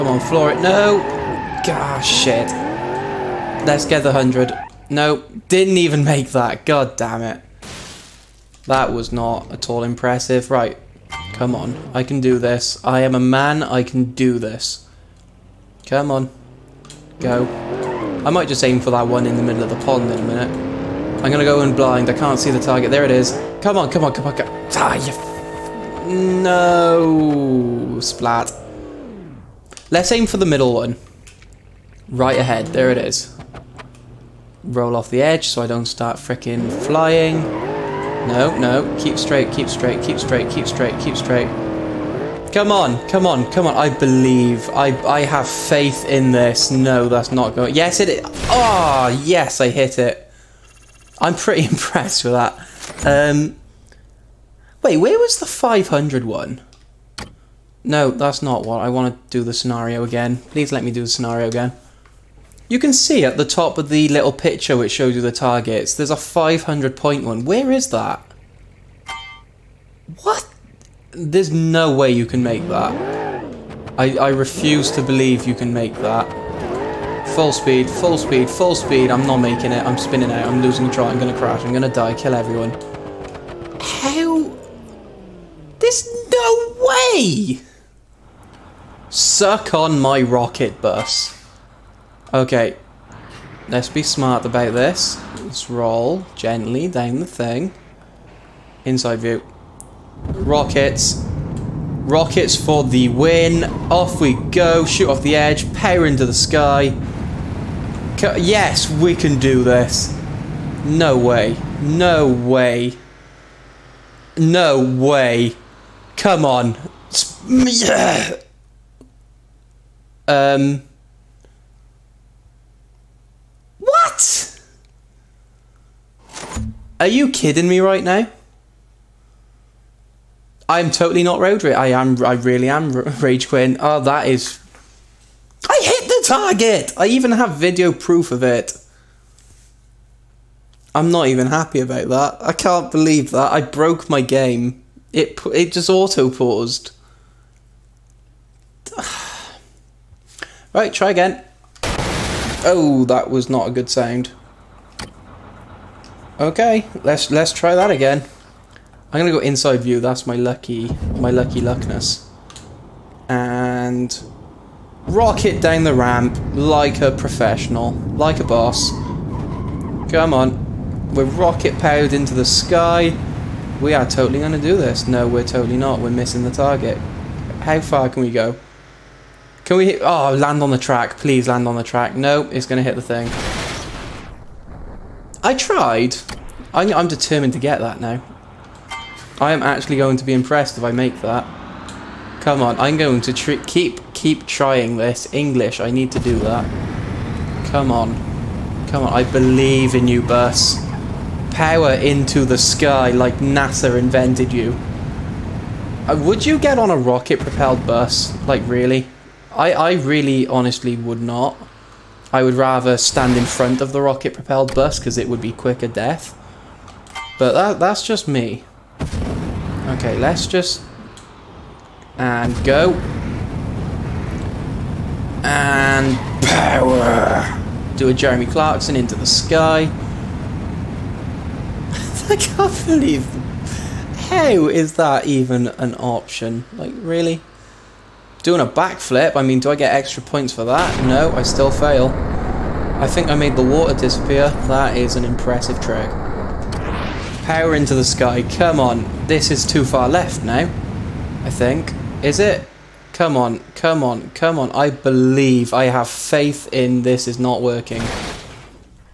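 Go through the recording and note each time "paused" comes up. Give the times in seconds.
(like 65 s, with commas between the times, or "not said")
146 s.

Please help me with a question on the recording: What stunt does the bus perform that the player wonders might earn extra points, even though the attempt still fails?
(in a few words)
backflip.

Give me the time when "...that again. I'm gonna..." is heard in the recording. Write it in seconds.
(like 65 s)
157 s.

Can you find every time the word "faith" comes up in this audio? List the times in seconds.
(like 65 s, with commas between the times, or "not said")
45 s, 256 s.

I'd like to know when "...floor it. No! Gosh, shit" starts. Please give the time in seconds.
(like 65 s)
0 s.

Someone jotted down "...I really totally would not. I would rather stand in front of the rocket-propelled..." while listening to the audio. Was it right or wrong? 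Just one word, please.
wrong.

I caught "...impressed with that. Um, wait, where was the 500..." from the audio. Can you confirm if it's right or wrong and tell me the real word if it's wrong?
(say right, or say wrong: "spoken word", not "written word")
right.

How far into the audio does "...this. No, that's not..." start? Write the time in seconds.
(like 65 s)
46 s.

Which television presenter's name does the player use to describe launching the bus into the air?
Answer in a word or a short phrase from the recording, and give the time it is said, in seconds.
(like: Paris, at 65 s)
Jeremy Clarkson, at 228 s.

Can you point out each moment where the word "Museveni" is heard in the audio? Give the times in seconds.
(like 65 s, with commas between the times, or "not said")
not said.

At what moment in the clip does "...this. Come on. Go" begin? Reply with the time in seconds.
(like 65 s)
14 s.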